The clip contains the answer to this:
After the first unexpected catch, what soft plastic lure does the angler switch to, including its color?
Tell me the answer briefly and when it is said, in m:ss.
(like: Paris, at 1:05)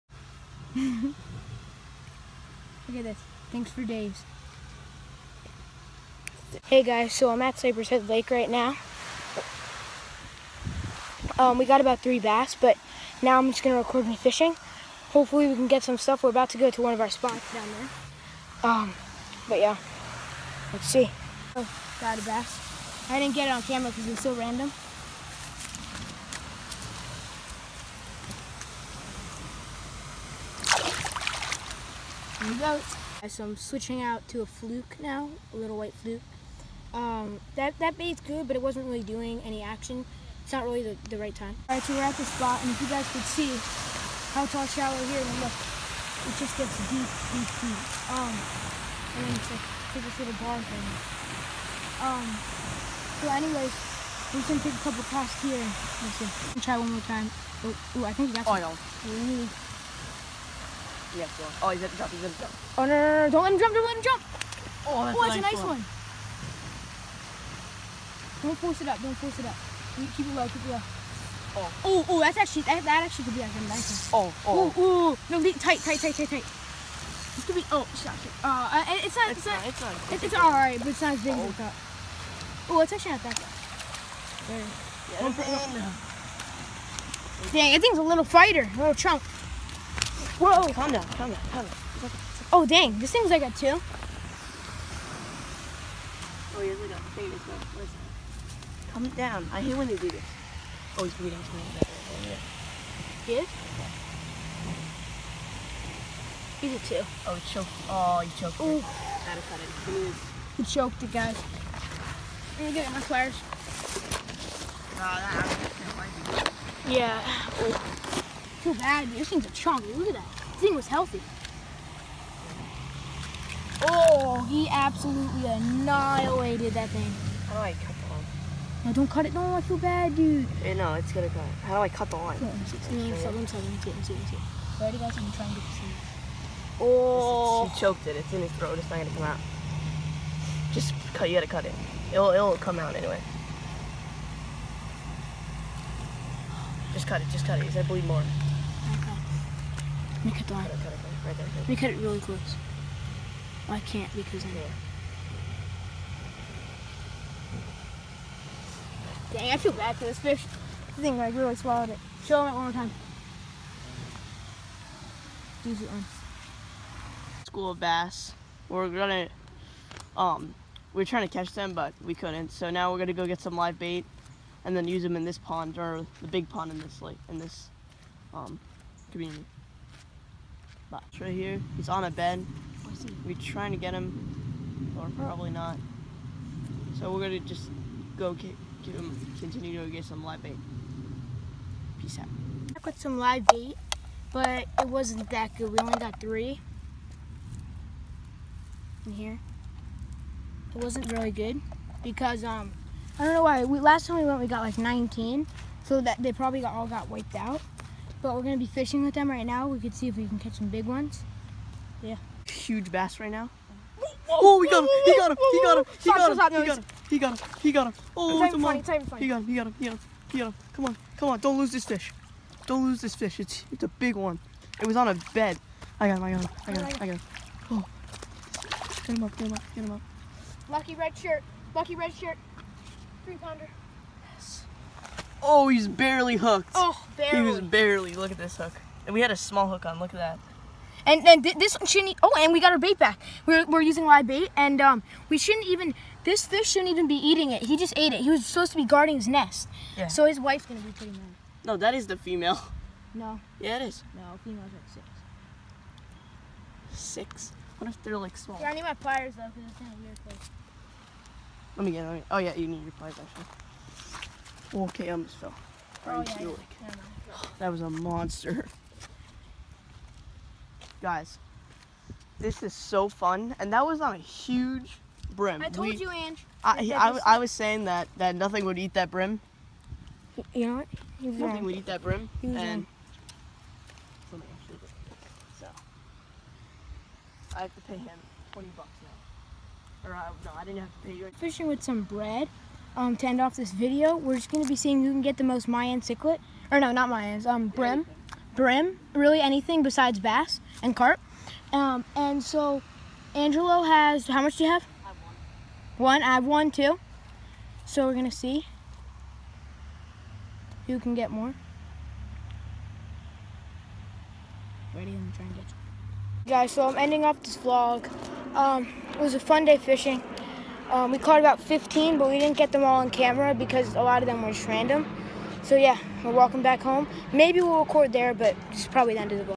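white fluke, at 0:35.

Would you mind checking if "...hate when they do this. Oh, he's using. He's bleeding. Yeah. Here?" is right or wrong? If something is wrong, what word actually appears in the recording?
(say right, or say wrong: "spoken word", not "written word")
wrong: "bleeding", not "using".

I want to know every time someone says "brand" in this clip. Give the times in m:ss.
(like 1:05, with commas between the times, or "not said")
not said.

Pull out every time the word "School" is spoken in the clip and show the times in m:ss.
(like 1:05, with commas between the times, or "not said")
2:47.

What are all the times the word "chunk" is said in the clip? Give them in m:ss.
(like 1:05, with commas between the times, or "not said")
1:28, 1:59.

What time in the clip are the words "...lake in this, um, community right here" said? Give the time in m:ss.
2:57.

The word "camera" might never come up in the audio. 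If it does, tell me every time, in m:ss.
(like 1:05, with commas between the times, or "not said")
0:23, 5:23.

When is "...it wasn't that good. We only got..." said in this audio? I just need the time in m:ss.
3:14.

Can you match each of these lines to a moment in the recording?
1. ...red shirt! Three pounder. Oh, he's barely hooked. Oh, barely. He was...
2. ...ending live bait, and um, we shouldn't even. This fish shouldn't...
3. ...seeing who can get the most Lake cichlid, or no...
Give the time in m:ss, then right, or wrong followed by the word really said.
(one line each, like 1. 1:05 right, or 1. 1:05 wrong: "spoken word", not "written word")
1. 3:51 right
2. 4:03 wrong: "using", not "ending"
3. 4:54 wrong: "Mayan", not "Lake".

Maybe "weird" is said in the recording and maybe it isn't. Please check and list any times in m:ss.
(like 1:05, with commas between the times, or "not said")
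4:20.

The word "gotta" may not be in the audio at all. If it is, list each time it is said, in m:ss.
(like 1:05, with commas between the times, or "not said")
1:48, 2:21.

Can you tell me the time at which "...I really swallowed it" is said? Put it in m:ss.
2:41.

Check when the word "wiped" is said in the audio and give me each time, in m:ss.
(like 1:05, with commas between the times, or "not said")
3:27.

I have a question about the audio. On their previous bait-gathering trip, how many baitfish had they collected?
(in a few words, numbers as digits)
19.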